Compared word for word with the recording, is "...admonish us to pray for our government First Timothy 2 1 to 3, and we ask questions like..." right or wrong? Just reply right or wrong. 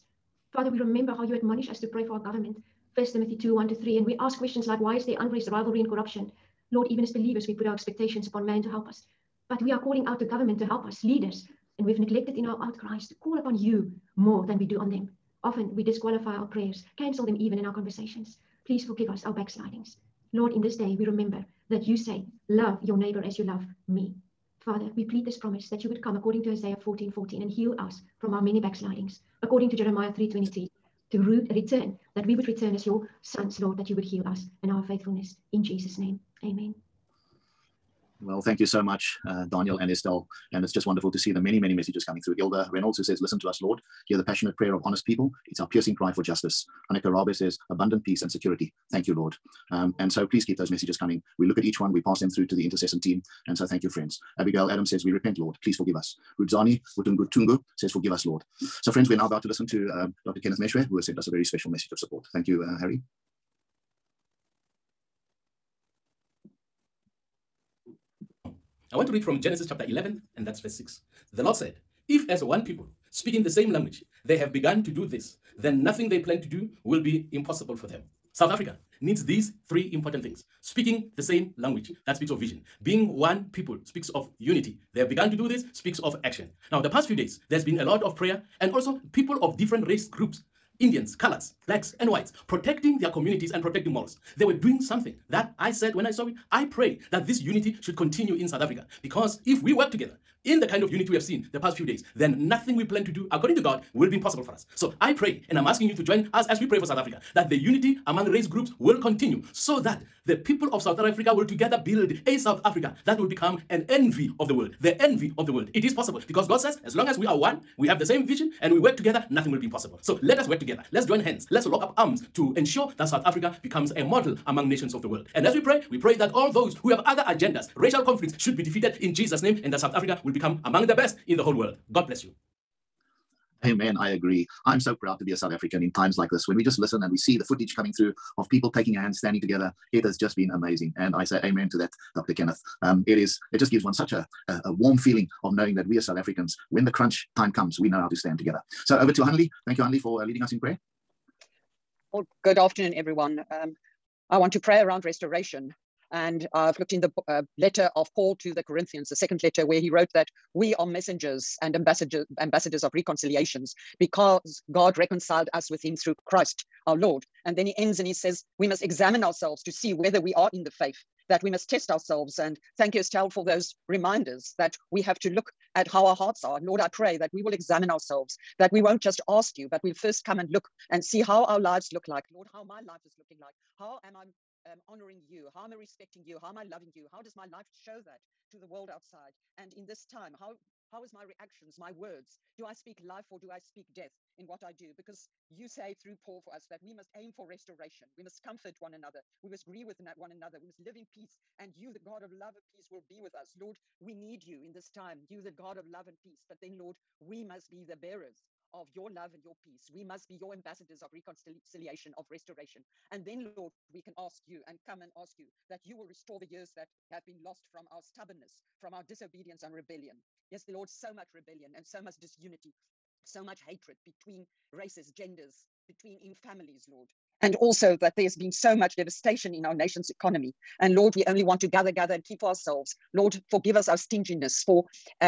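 right.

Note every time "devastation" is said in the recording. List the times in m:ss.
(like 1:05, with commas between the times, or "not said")
3:48.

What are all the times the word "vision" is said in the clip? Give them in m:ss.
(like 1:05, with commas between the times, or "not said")
1:22, 1:58.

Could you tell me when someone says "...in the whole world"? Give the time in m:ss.
2:11.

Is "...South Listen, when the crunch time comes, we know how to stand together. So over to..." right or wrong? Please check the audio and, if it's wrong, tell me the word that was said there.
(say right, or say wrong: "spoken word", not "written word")
wrong: "Africans", not "Listen".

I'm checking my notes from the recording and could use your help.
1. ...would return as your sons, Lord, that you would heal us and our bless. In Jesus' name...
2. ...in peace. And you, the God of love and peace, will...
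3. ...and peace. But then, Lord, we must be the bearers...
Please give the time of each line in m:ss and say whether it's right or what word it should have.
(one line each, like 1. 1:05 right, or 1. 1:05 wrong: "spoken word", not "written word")
1. 0:32 wrong: "faithfulness", not "bless"
2. 3:20 right
3. 3:26 right.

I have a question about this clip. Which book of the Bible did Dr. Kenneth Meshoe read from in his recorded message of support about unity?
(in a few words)
Genesis.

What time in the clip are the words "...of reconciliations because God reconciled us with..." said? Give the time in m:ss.
2:42.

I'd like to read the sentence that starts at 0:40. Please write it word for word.
And it's just wonderful to see the many, many messages coming through.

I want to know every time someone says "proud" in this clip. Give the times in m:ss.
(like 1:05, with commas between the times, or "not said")
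2:14.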